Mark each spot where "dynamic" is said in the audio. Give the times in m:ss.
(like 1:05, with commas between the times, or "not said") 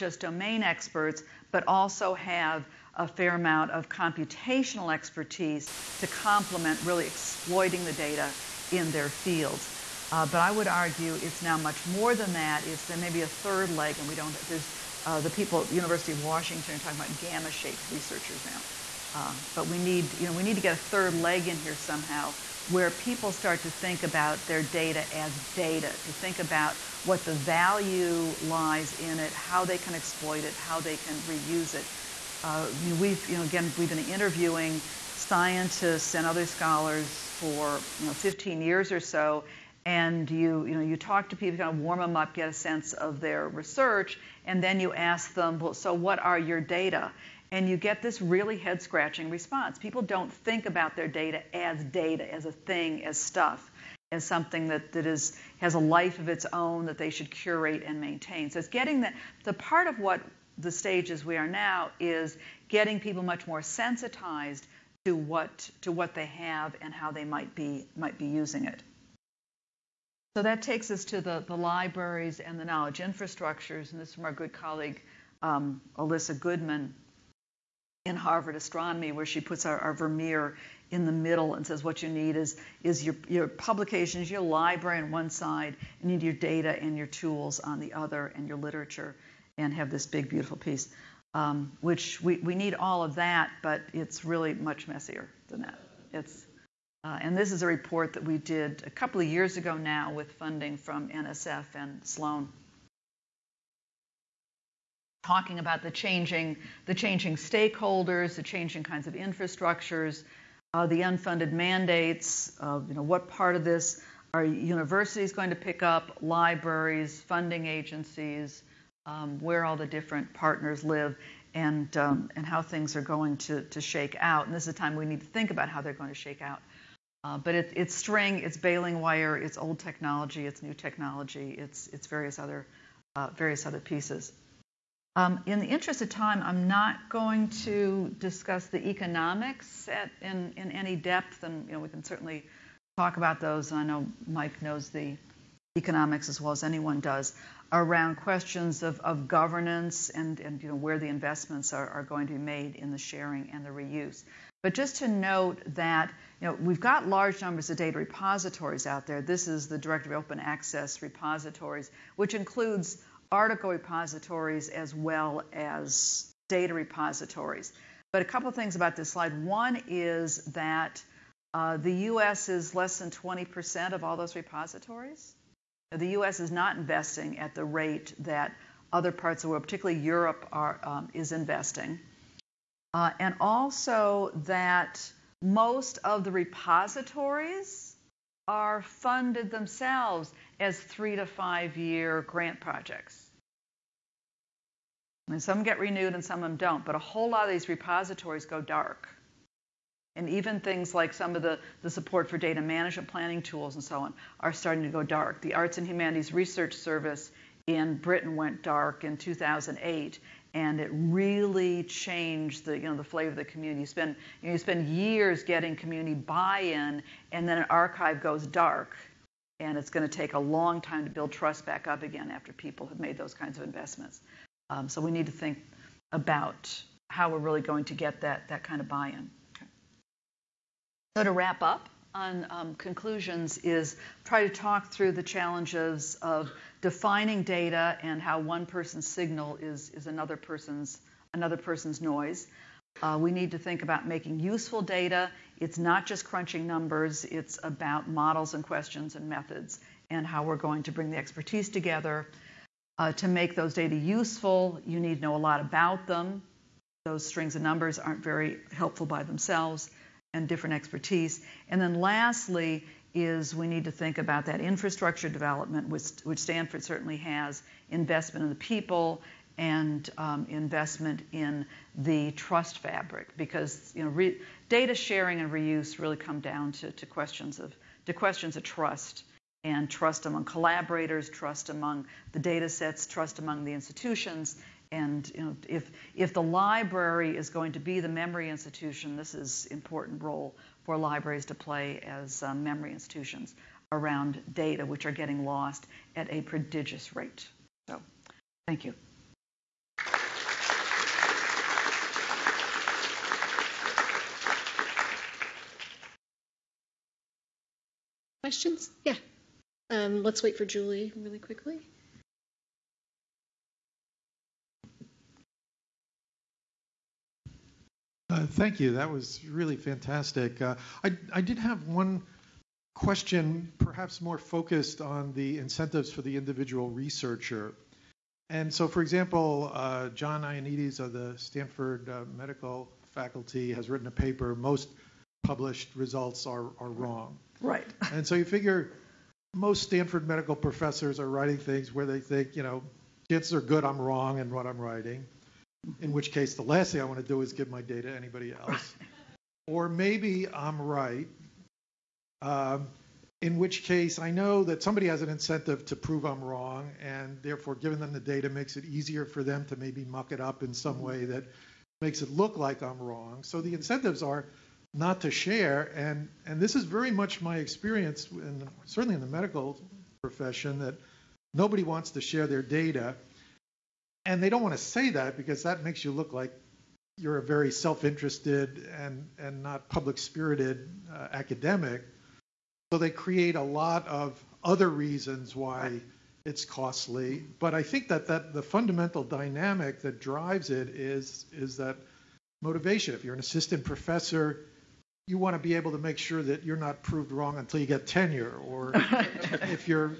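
6:29.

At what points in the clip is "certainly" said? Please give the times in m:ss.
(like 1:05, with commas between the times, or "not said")
2:22, 4:26, 6:08.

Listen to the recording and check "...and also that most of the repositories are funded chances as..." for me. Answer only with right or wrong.
wrong.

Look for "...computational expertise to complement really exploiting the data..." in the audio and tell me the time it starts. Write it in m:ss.
0:03.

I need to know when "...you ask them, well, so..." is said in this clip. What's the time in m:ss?
0:44.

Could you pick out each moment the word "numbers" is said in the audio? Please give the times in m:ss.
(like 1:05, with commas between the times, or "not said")
2:37, 4:06, 4:17.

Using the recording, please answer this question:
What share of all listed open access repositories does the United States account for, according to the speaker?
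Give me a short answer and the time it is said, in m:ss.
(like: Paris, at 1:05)
less than 20%, at 2:52.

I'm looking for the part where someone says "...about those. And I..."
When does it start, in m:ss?
2:23.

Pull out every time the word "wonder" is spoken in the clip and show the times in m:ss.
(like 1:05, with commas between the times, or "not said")
not said.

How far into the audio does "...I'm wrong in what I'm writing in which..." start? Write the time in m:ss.
5:43.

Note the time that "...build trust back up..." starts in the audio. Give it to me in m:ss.
3:41.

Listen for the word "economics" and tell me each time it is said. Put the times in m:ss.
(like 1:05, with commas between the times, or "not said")
2:18, 2:25.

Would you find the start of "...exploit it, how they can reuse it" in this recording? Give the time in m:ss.
0:29.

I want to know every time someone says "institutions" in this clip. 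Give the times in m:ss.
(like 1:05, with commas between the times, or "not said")
4:43, 4:48, 4:52.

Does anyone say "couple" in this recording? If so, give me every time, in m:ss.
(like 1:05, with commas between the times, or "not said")
1:38, 2:48.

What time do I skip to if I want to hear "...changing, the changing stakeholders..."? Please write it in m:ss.
1:45.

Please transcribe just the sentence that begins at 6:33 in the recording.
If you're an assistant professor, you want to be able to make sure that you're not proved wrong until you get tenure.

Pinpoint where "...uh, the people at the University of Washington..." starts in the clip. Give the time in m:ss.
0:15.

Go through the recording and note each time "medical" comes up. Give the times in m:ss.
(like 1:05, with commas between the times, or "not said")
5:32, 5:40, 6:09.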